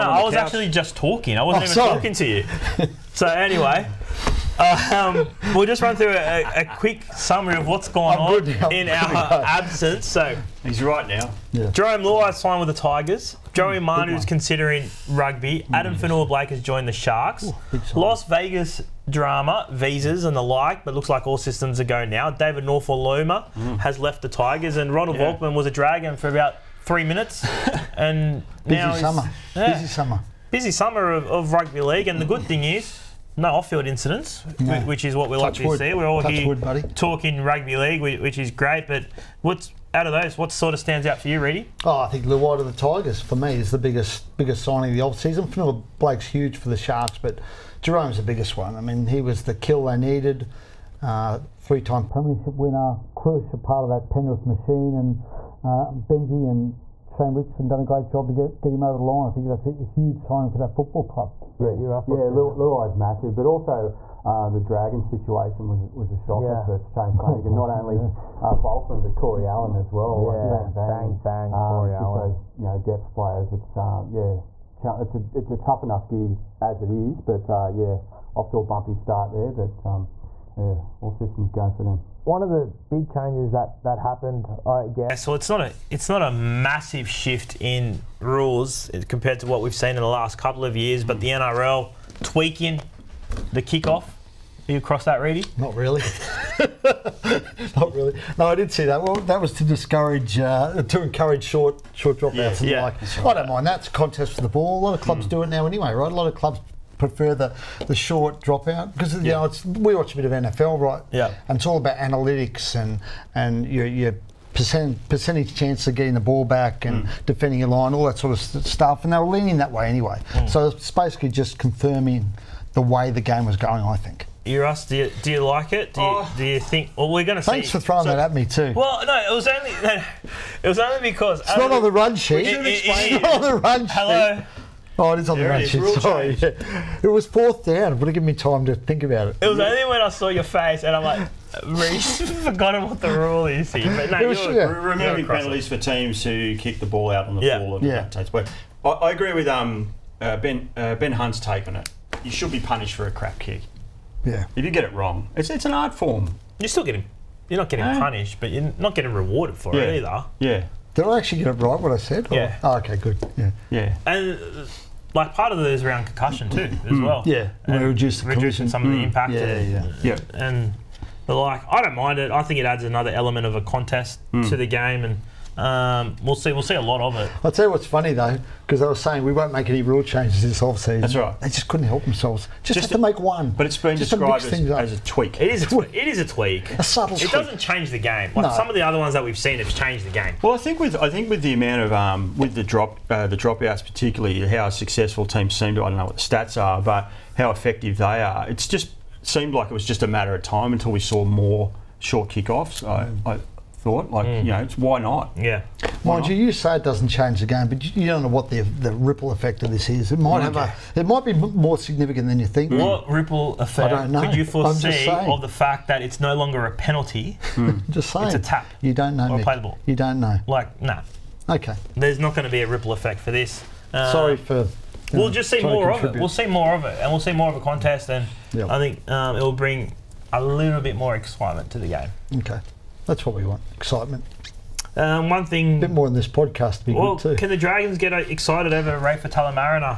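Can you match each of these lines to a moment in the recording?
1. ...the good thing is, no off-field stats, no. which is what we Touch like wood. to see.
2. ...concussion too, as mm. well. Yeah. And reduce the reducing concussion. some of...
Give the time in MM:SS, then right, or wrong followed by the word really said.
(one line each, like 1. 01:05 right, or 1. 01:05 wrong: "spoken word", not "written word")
1. 00:32 wrong: "incidents", not "stats"
2. 02:46 right.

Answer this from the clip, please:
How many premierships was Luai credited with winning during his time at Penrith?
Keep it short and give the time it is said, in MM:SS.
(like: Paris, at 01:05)
3, at 00:51.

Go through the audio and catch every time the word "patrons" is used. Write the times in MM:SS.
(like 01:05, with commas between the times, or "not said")
not said.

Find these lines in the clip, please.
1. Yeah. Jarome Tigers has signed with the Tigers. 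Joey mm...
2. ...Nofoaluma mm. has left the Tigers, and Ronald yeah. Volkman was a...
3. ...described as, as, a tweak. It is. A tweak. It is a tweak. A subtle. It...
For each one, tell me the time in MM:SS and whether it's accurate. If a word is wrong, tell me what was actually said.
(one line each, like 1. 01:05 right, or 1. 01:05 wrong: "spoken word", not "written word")
1. 00:11 wrong: "Luai", not "Tigers"
2. 00:22 right
3. 03:04 right.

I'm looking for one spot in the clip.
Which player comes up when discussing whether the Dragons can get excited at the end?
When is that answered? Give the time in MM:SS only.
03:58.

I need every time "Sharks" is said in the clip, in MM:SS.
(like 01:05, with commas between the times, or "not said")
00:16, 00:46.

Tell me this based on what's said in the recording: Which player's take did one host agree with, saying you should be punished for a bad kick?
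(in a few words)
Ben Hunt.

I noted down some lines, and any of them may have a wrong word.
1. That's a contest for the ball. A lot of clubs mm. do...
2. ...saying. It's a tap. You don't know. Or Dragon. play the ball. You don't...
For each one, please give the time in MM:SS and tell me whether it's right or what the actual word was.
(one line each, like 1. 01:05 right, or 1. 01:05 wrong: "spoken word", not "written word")
1. 01:43 right
2. 03:38 wrong: "Mick", not "Dragon".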